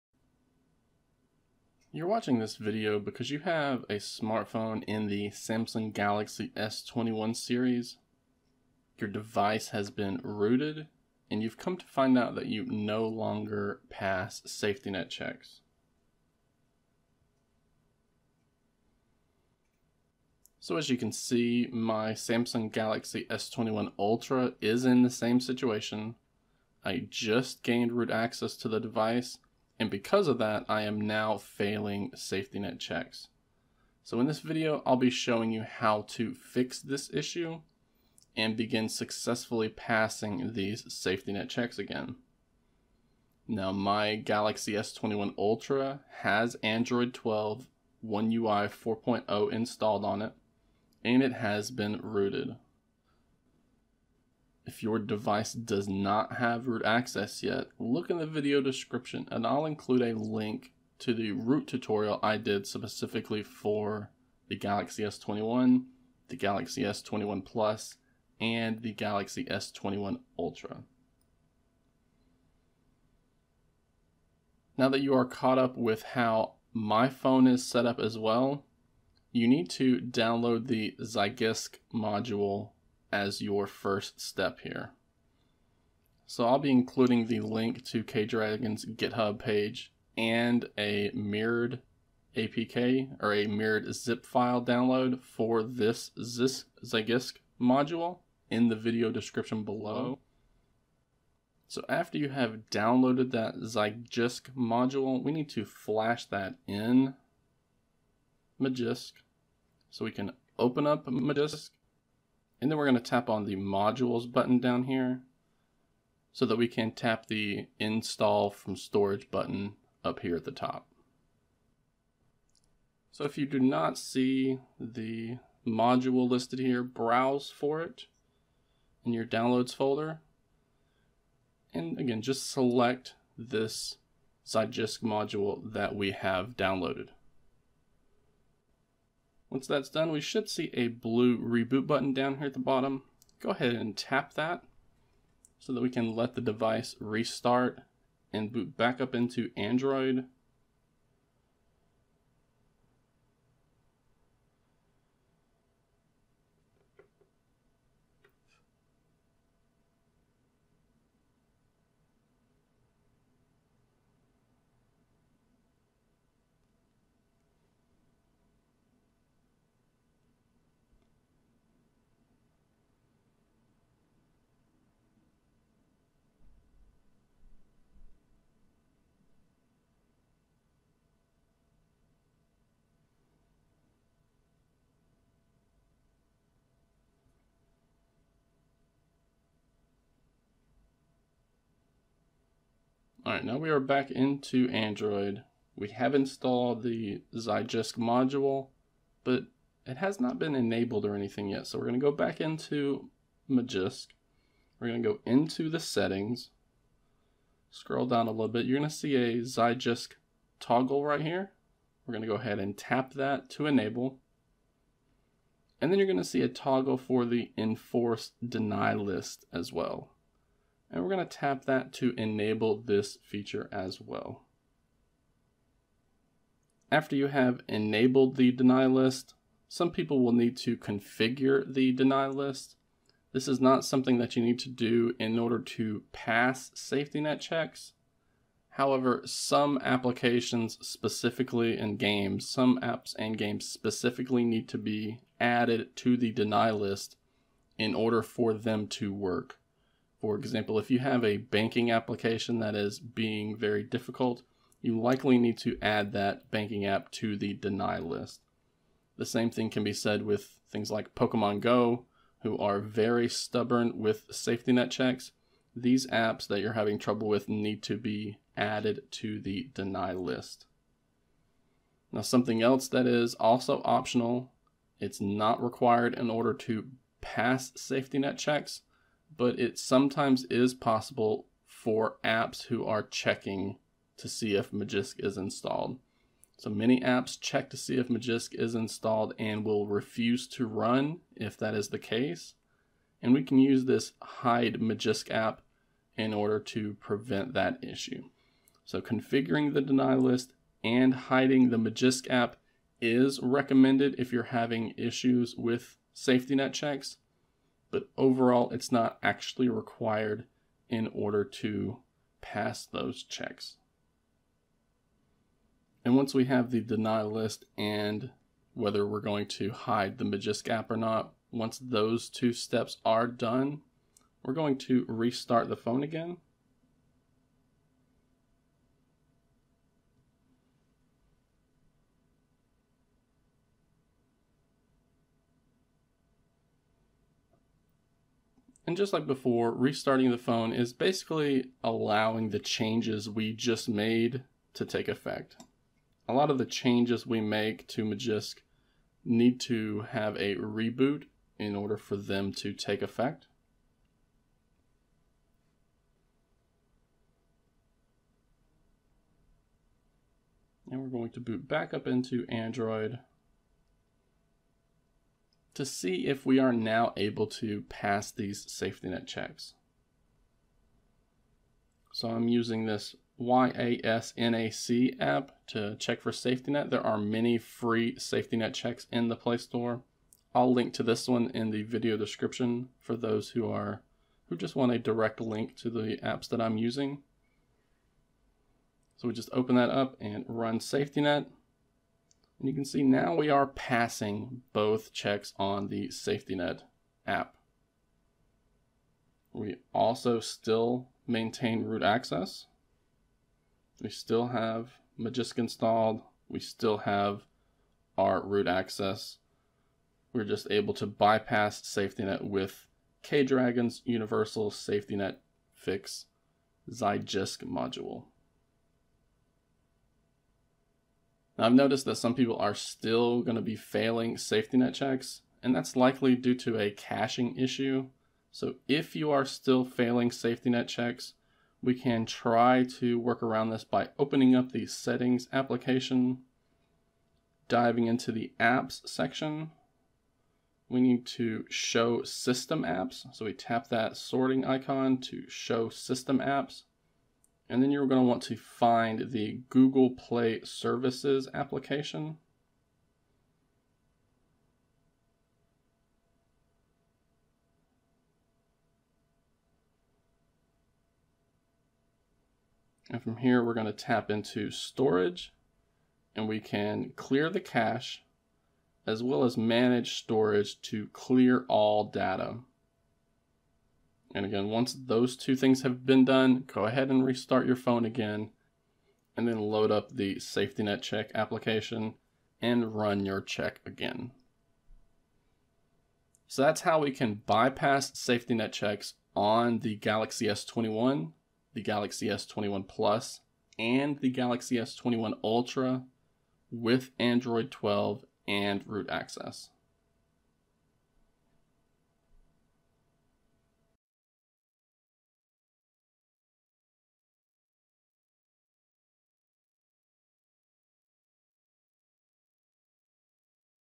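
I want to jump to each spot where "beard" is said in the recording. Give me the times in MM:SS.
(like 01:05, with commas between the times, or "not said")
not said.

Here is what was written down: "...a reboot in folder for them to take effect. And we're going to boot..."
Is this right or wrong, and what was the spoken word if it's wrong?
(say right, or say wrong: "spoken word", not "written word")
wrong: "order", not "folder".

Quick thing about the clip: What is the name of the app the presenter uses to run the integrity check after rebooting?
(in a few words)
YASNAC.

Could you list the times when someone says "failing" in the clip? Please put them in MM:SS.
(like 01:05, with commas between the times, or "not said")
00:31, 07:03, 07:09.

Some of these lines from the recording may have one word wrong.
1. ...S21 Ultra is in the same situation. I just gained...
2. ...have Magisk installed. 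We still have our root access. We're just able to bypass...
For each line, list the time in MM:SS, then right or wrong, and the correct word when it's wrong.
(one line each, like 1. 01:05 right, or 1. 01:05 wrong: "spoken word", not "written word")
1. 00:23 right
2. 06:44 right.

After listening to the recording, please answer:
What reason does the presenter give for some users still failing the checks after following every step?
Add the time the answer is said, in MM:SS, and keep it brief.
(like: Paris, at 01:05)
A caching issue, at 07:06.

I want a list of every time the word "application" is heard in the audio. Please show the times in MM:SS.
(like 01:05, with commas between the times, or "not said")
03:59, 04:11, 07:15, 07:31, 08:01.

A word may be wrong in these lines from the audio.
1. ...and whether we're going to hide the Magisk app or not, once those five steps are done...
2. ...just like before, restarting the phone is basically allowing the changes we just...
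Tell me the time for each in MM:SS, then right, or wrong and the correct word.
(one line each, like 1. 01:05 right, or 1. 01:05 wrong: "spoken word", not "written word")
1. 05:17 wrong: "two", not "five"
2. 05:38 right.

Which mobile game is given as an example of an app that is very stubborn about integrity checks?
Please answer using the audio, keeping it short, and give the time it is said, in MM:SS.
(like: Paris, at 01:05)
Pokemon Go, at 04:21.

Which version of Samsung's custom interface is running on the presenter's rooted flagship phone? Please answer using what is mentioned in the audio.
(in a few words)
One UI 4.0.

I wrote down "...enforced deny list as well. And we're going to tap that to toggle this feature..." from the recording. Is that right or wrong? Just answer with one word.
wrong.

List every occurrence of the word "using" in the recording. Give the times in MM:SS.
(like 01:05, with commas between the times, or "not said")
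06:12, 06:26.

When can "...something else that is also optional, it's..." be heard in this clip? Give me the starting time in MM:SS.
04:32.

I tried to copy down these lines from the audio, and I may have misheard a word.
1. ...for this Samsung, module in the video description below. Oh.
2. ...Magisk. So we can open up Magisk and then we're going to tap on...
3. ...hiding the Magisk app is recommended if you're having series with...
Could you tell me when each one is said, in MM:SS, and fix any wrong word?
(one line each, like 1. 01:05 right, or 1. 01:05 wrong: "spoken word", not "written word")
1. 01:35 wrong: "Zygisk", not "Samsung"
2. 01:48 right
3. 05:01 wrong: "issues", not "series".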